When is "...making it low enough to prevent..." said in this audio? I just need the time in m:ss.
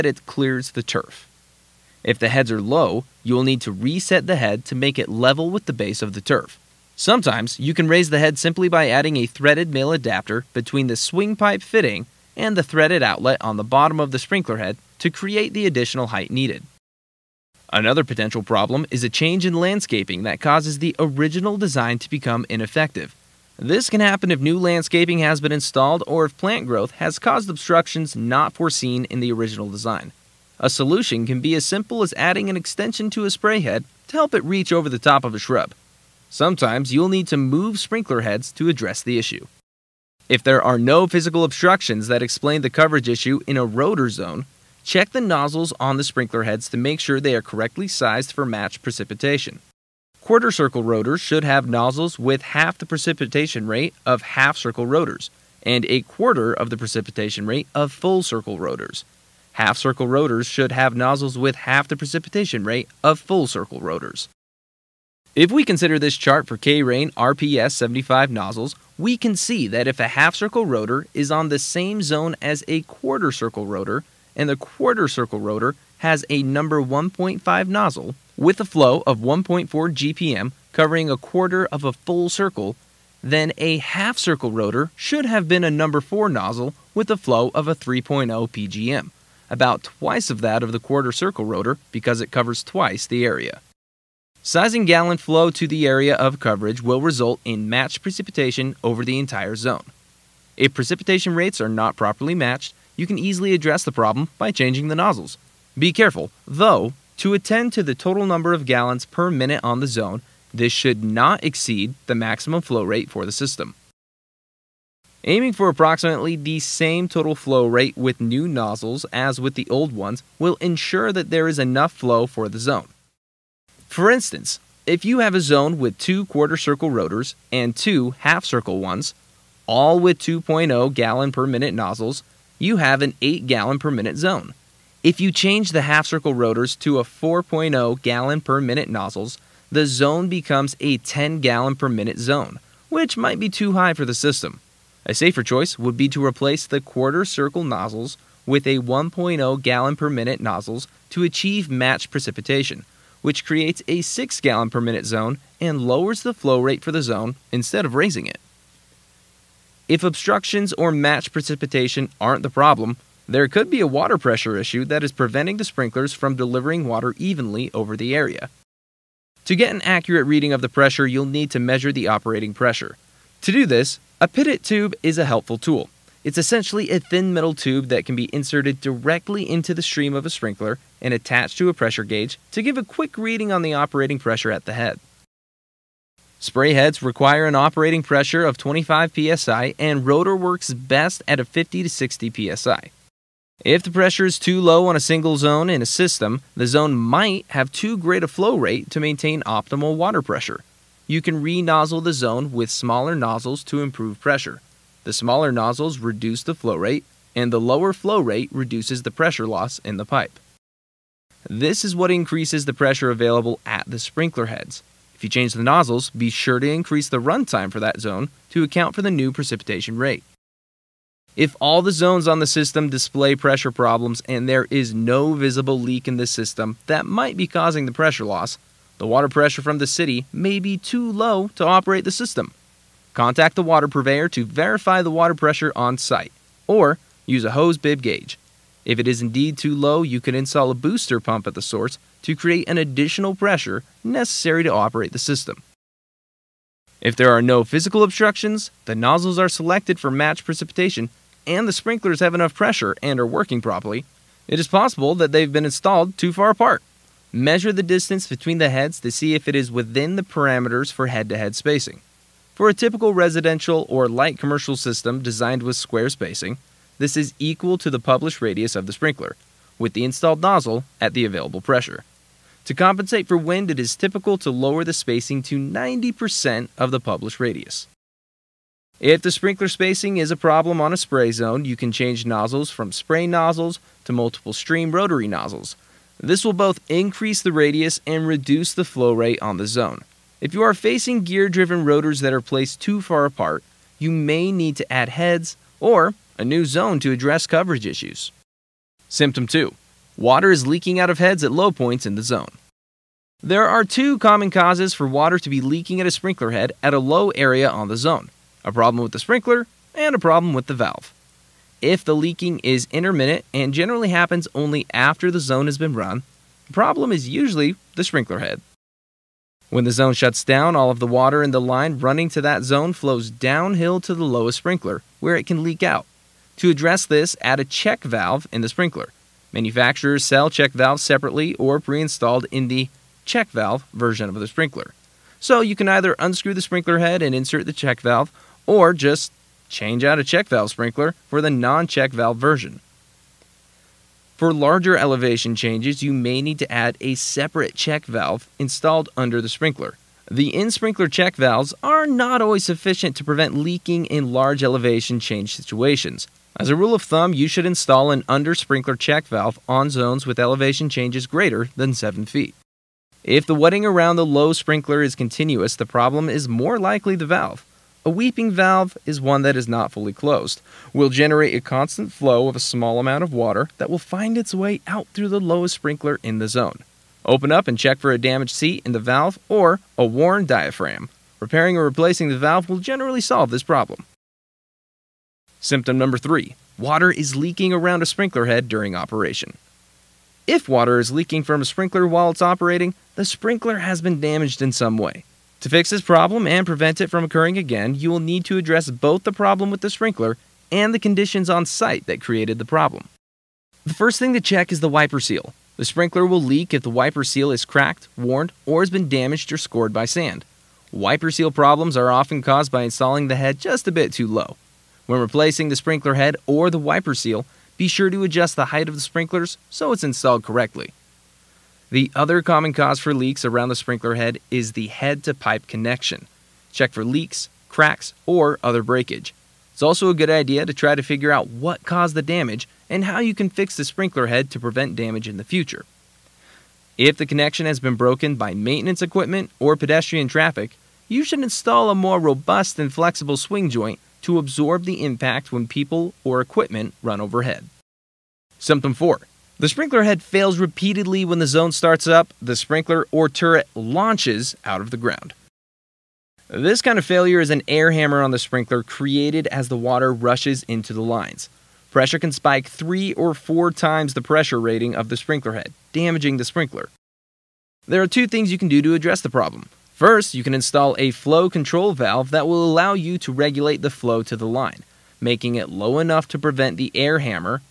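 7:55.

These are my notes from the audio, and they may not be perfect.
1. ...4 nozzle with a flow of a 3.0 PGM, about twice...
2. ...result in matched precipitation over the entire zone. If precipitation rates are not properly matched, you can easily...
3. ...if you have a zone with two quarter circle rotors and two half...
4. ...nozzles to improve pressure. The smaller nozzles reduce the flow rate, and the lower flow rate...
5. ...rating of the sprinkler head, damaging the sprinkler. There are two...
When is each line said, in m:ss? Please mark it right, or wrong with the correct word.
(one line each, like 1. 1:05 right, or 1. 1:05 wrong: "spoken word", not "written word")
1. 1:25 right
2. 1:37 right
3. 2:04 right
4. 3:23 right
5. 7:44 right.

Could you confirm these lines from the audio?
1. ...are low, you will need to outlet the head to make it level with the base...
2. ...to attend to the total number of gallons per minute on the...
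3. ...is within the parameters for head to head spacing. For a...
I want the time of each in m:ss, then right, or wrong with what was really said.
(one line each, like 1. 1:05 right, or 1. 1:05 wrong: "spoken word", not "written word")
1. 0:02 wrong: "reset", not "outlet"
2. 1:47 right
3. 4:19 right.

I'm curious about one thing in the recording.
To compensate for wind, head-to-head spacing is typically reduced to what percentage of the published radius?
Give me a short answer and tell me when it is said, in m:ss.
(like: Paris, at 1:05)
90%, at 4:35.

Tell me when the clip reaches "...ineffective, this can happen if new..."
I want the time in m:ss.
0:22.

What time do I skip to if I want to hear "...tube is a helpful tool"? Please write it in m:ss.
2:54.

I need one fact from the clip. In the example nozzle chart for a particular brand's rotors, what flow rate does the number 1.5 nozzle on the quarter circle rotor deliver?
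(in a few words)
1.4 GPM.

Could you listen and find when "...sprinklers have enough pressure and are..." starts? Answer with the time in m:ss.
4:11.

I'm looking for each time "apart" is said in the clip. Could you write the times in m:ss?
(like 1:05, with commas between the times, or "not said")
4:16, 4:53.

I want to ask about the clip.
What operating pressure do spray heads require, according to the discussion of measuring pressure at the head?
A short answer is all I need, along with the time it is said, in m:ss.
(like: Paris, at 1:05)
25 psi, at 3:08.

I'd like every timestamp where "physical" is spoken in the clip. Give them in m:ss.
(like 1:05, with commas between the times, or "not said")
0:41, 4:07.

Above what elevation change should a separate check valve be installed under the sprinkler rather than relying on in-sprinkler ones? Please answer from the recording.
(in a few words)
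7 feet.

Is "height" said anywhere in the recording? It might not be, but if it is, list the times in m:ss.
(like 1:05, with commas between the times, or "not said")
0:16, 6:58.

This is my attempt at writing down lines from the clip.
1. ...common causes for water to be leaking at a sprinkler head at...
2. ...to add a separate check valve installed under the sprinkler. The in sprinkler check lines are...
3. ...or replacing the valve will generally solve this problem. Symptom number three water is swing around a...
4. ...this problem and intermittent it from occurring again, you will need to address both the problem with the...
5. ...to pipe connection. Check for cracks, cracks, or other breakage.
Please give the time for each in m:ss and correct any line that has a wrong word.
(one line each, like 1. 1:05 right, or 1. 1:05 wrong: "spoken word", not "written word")
1. 5:04 right
2. 5:46 wrong: "valves", not "lines"
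3. 6:21 wrong: "leaking", not "swing"
4. 6:35 wrong: "prevent", not "intermittent"
5. 7:05 wrong: "leaks", not "cracks".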